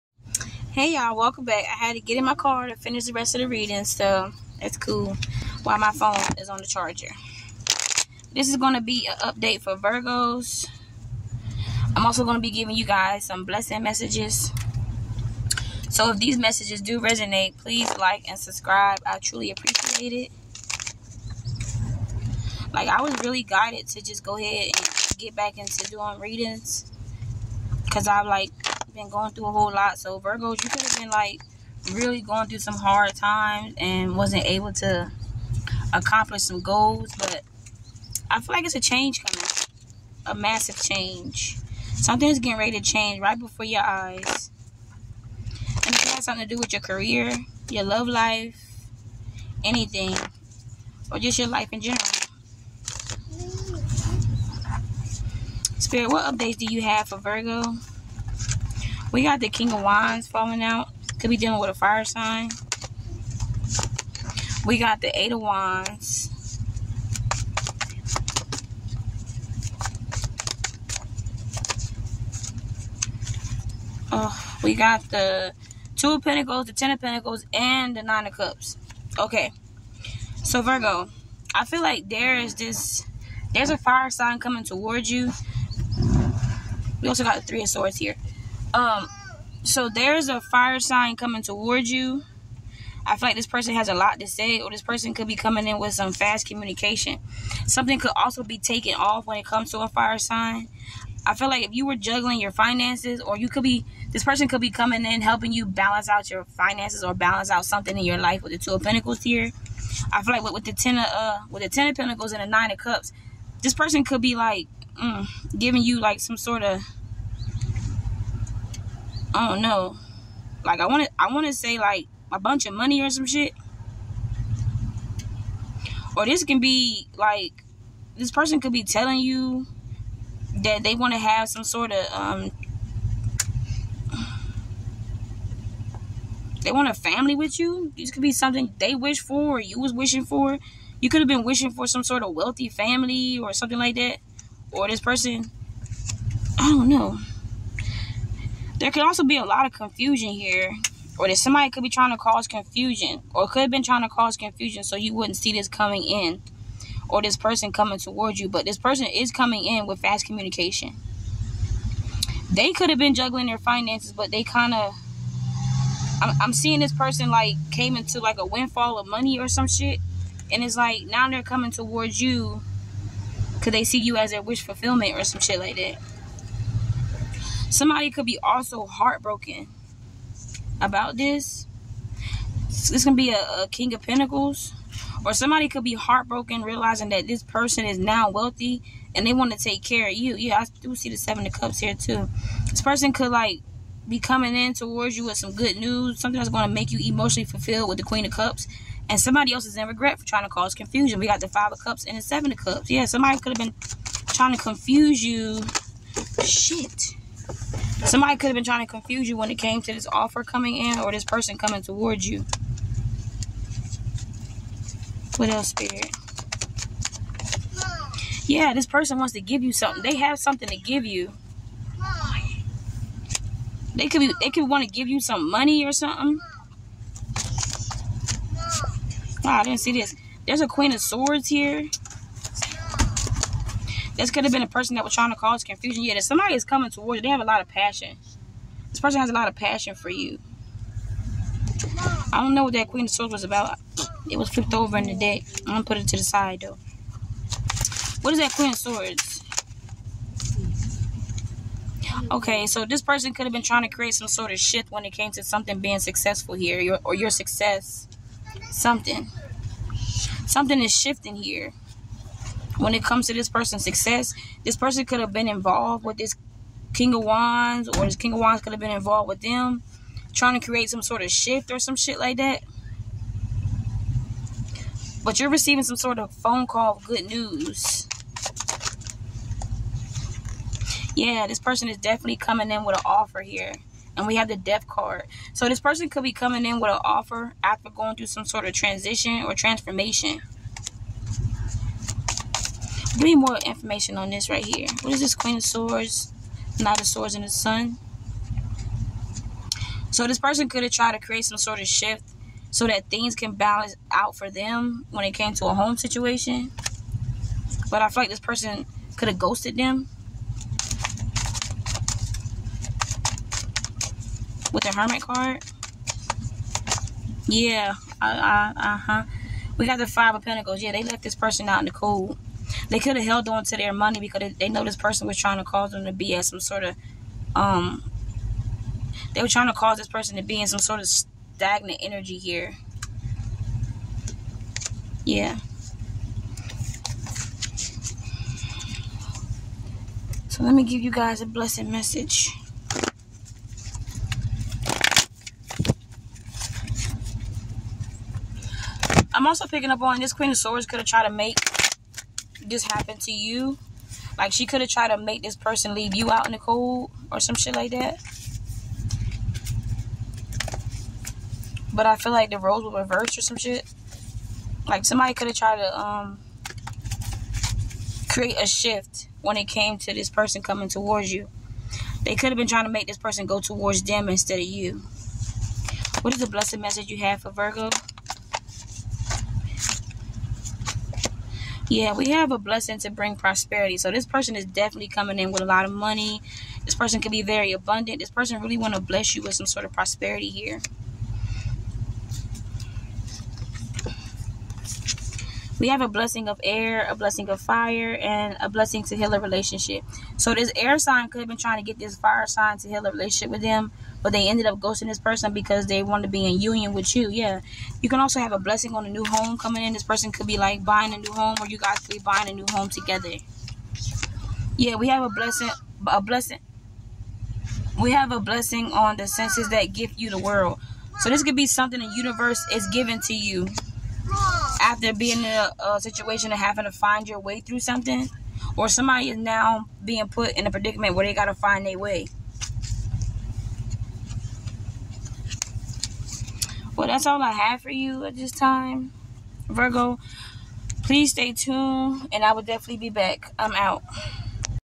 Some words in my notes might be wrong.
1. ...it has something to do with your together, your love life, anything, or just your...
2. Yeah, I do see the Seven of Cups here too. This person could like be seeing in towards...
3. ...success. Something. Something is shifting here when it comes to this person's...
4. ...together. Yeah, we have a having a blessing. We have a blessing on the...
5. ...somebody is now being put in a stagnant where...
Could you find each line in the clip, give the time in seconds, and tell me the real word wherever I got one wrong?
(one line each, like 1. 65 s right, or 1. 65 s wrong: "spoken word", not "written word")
1. 45 s wrong: "career", not "together"
2. 190 s wrong: "coming", not "seeing"
3. 257 s right
4. 412 s wrong: "blessing", not "having"
5. 428 s wrong: "predicament", not "stagnant".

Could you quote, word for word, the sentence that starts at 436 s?
Well, that's all I have for you at this time, Virgo.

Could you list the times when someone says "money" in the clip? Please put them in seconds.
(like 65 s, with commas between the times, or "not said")
122 s, 169 s, 225 s, 323 s, 385 s.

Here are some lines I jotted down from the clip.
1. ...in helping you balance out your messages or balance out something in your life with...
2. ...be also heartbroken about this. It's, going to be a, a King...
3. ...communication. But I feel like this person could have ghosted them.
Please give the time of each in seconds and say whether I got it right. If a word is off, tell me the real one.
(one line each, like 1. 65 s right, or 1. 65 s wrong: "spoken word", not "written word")
1. 105 s wrong: "finances", not "messages"
2. 178 s right
3. 305 s wrong: "situation", not "communication".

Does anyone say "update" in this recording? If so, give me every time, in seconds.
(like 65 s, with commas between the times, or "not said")
9 s, 56 s.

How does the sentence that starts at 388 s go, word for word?
This person really want to bless you with some sort of prosperity here.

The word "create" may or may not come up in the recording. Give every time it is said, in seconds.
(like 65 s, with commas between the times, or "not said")
253 s, 270 s, 301 s, 368 s.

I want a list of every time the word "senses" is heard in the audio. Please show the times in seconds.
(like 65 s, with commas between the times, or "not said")
419 s.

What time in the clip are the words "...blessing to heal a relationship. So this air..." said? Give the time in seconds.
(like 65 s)
398 s.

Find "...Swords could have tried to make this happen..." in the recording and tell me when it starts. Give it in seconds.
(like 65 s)
350 s.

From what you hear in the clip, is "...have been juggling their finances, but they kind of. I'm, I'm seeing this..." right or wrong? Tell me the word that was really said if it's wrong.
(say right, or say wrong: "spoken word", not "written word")
right.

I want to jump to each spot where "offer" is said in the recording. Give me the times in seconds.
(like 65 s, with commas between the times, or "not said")
210 s, 283 s, 287 s.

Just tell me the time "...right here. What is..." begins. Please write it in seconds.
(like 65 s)
294 s.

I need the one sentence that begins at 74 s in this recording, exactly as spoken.
Oh, we got the Two of Pentacles, the Ten of Pentacles, and the Nine of Cups.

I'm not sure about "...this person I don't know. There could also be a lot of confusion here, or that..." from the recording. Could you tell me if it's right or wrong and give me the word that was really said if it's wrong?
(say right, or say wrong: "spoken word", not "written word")
right.